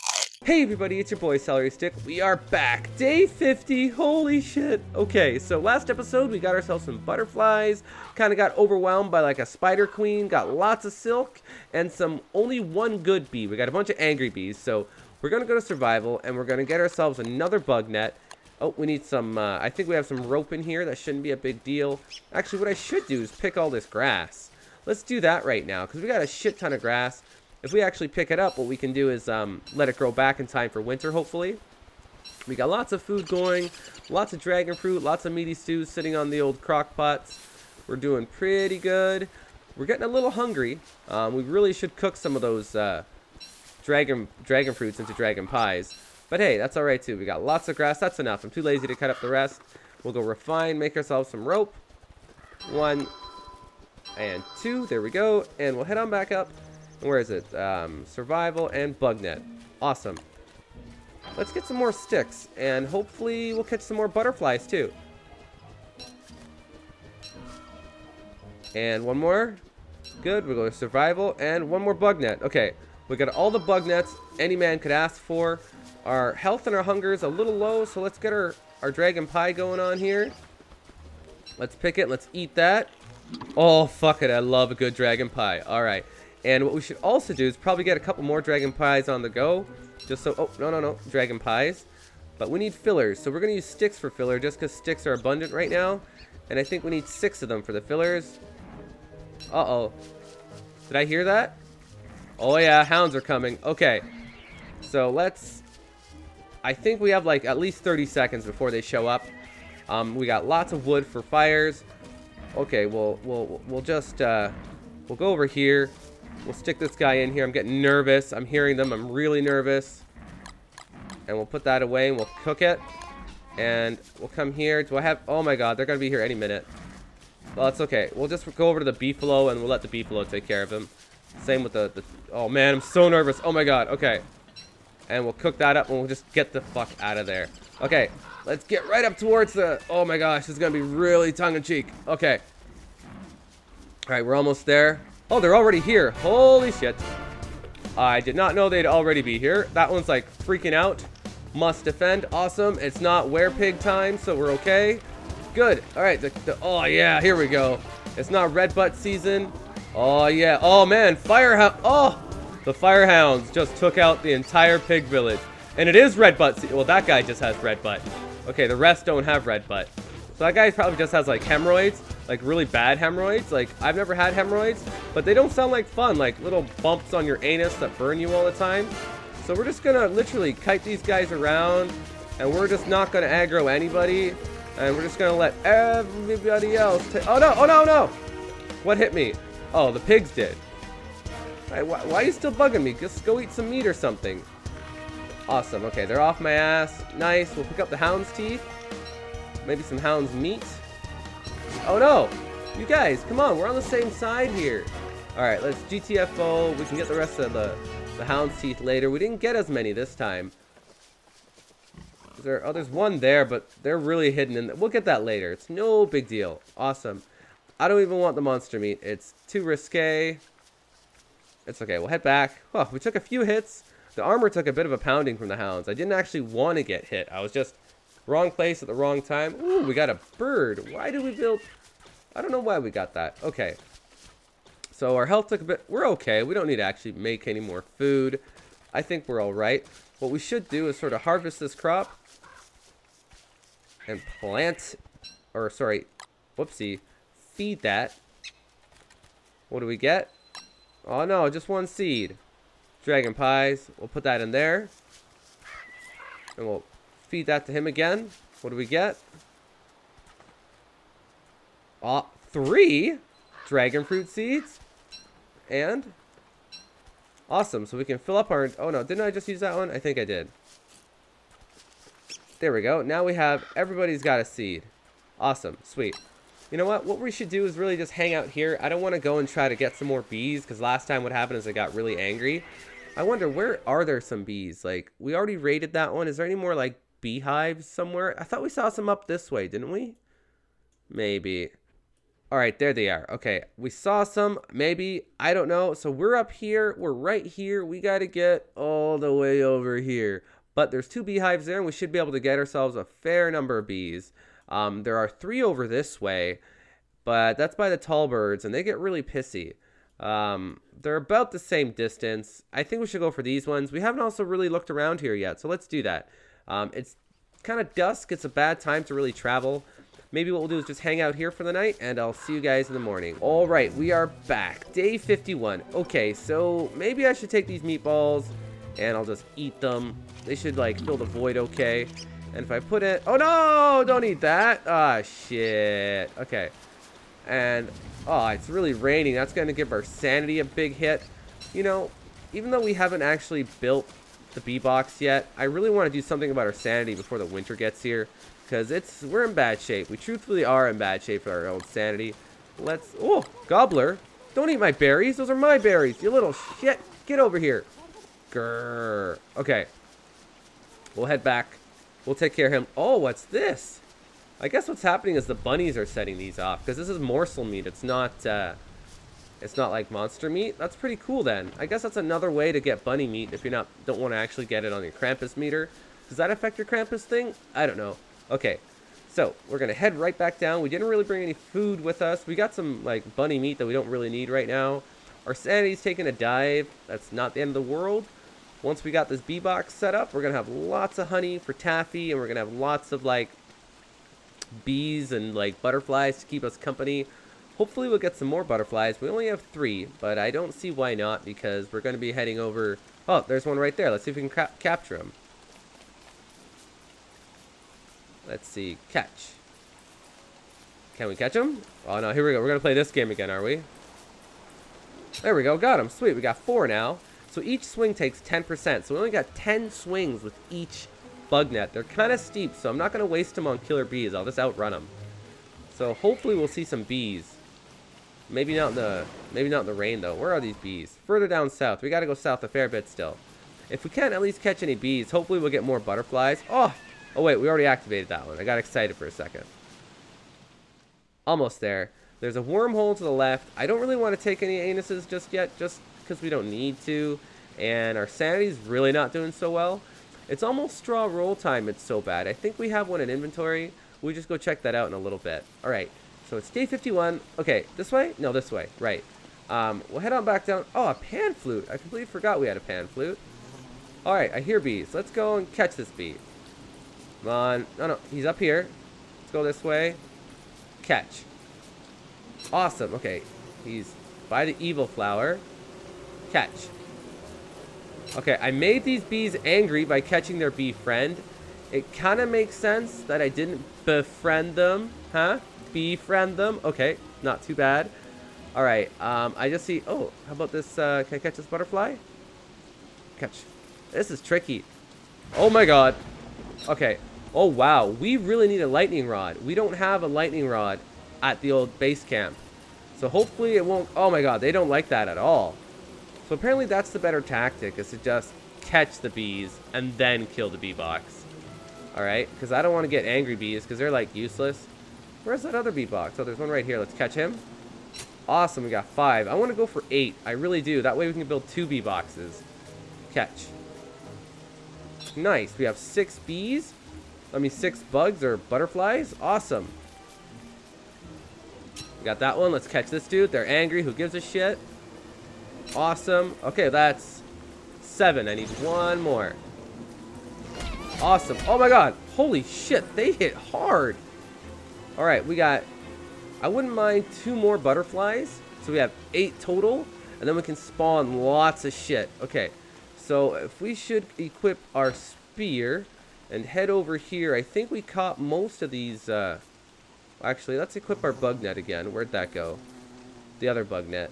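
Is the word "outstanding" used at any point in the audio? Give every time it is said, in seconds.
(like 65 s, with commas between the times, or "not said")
not said.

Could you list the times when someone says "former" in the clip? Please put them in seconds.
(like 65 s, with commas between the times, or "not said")
not said.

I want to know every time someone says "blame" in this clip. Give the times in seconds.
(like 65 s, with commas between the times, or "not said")
not said.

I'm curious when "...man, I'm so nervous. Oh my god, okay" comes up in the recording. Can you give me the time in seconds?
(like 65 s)
132 s.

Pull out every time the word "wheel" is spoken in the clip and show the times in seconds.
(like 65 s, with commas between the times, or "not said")
not said.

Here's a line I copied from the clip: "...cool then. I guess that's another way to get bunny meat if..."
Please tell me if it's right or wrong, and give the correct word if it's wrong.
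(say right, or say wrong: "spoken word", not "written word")
right.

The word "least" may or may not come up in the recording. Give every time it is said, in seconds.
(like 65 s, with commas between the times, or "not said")
107 s, 434 s.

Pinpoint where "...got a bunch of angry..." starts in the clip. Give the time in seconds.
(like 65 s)
13 s.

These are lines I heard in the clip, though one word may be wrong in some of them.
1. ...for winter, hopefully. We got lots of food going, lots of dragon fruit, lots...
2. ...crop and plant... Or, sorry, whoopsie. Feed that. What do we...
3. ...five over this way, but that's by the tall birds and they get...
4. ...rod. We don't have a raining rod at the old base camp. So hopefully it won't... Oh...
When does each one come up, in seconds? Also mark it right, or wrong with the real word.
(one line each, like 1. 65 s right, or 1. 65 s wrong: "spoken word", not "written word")
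1. 30 s right
2. 241 s right
3. 305 s wrong: "three", not "five"
4. 499 s wrong: "lightning", not "raining".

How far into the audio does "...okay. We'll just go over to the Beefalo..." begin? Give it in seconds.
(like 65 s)
127 s.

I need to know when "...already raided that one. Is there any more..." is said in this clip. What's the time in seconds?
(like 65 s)
285 s.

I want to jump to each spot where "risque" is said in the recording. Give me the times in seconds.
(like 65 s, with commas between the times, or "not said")
219 s.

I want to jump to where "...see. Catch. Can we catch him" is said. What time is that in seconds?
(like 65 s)
408 s.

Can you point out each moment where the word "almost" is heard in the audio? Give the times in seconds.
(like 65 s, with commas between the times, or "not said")
144 s, 441 s, 450 s.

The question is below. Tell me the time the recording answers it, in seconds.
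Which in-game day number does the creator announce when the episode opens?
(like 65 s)
2 s.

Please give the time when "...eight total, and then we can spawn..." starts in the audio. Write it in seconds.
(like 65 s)
549 s.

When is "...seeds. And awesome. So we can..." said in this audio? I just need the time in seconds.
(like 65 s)
264 s.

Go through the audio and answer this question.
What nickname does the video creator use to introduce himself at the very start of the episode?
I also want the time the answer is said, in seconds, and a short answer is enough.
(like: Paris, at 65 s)
Celery Stick, at 1 s.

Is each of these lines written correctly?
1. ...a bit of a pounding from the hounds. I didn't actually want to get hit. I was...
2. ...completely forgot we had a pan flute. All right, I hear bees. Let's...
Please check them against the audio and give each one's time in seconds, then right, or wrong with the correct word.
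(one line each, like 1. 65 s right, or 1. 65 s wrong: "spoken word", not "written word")
1. 224 s right
2. 461 s right.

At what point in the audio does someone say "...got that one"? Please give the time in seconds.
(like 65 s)
532 s.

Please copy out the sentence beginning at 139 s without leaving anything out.
Oh my gosh, it's going to be really tongue-in-cheek.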